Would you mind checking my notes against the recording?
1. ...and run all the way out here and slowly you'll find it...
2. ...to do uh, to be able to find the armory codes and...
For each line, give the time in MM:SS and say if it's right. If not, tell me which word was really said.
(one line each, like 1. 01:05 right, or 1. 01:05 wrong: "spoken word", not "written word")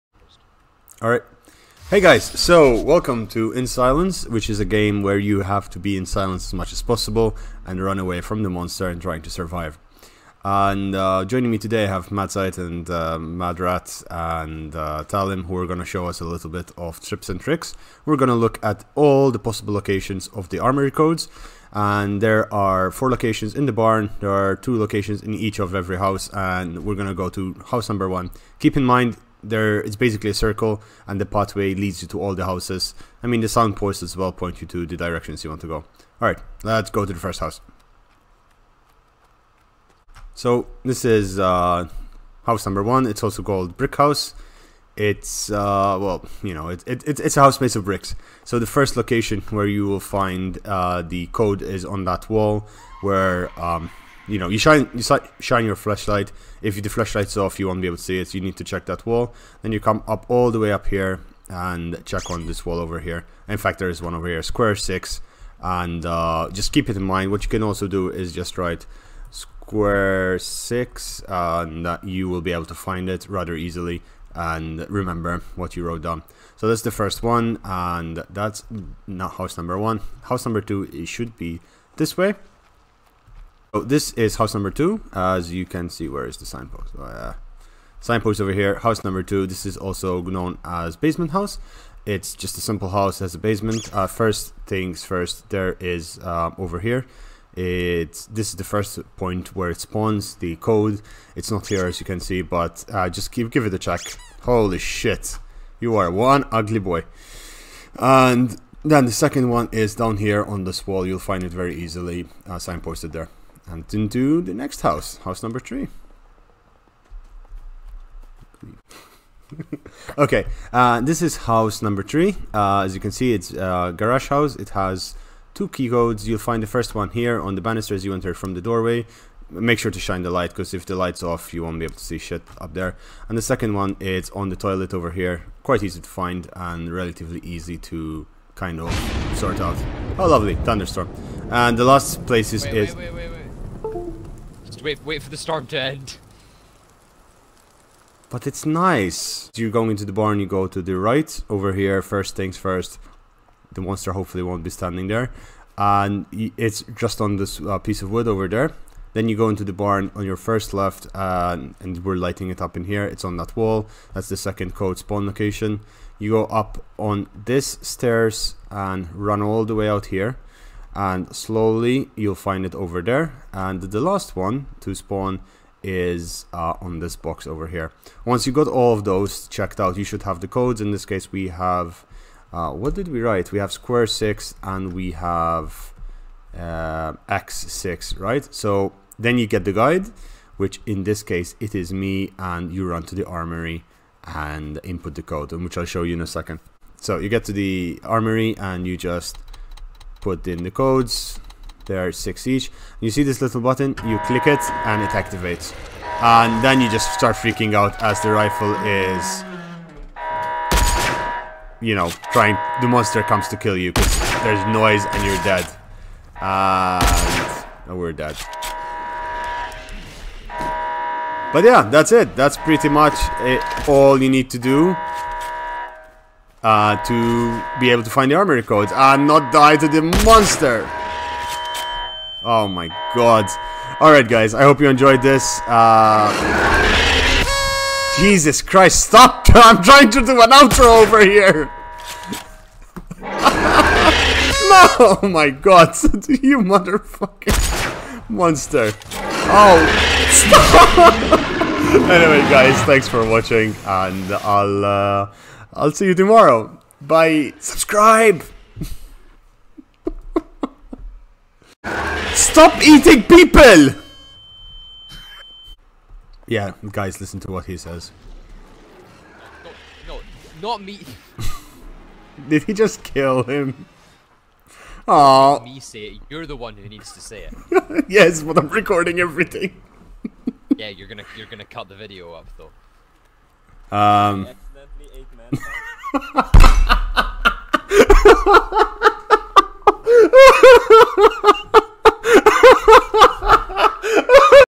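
1. 02:48 right
2. 03:44 right.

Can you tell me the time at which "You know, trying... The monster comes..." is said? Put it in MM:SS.
03:31.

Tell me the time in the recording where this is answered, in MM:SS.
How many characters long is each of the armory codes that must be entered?
03:22.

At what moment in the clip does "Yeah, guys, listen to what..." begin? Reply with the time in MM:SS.
04:26.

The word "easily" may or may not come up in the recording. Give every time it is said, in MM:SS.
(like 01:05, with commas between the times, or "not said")
01:13, 01:51.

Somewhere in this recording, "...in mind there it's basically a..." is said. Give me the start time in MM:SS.
00:28.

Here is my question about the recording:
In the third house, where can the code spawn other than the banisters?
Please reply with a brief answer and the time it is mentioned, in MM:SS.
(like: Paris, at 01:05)
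the toilet, at 02:14.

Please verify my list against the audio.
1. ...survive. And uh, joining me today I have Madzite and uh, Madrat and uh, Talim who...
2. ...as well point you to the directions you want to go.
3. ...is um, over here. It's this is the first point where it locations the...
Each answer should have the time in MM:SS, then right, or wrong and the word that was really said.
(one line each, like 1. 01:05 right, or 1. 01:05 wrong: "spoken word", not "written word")
1. 00:09 right
2. 00:34 right
3. 01:35 wrong: "spawns", not "locations".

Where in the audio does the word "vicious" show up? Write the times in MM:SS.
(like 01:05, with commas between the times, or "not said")
not said.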